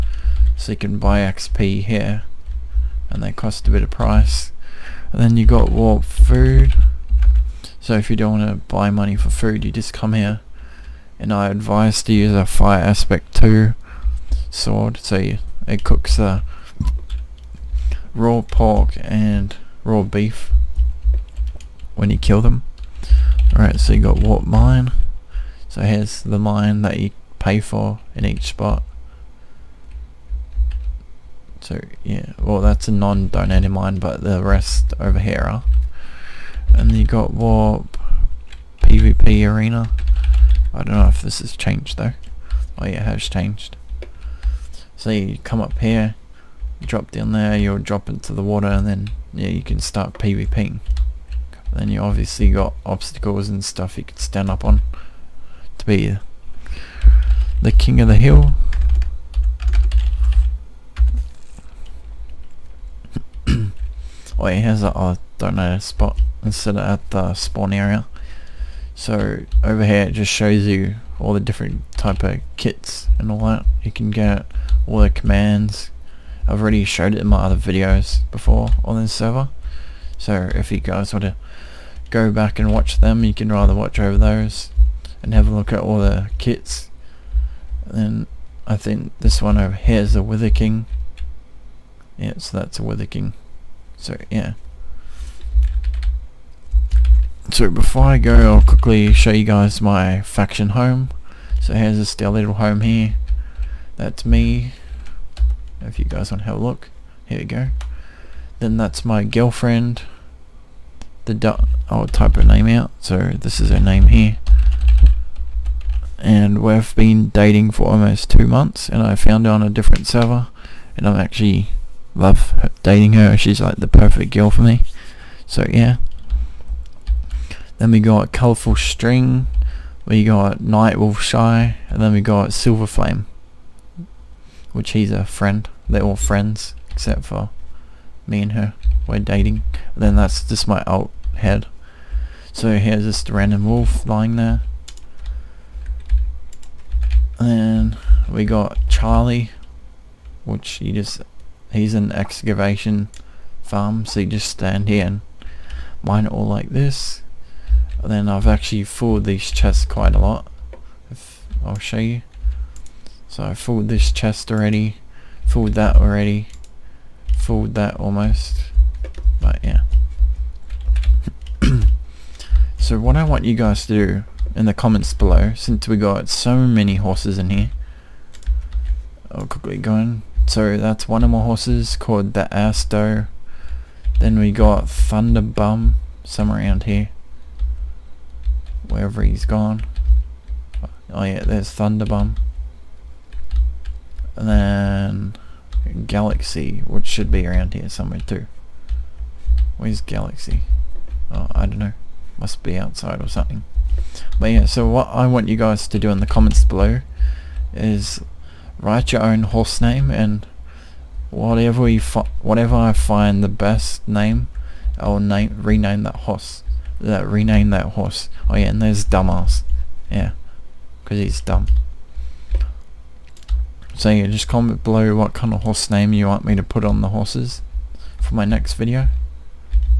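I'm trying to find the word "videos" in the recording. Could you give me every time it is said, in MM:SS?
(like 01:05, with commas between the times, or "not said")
01:17, 03:48.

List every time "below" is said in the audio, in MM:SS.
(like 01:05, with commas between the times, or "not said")
02:55, 03:26, 03:44.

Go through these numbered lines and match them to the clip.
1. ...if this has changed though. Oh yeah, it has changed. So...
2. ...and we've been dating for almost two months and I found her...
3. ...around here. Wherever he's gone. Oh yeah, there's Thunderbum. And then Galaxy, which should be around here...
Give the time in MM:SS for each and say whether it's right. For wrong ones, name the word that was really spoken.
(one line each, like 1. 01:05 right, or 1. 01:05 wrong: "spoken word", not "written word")
1. 00:41 right
2. 01:56 right
3. 03:06 right.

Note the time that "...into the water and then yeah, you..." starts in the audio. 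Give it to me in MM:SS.
00:48.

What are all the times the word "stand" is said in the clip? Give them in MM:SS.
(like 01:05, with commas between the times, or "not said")
00:54, 02:34.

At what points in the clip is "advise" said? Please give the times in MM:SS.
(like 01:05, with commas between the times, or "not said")
00:11.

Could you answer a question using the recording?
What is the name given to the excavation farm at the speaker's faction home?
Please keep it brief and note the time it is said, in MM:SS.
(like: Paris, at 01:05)
Charlie, at 02:28.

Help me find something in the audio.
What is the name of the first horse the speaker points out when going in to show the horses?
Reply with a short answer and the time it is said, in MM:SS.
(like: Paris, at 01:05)
Asto, at 03:02.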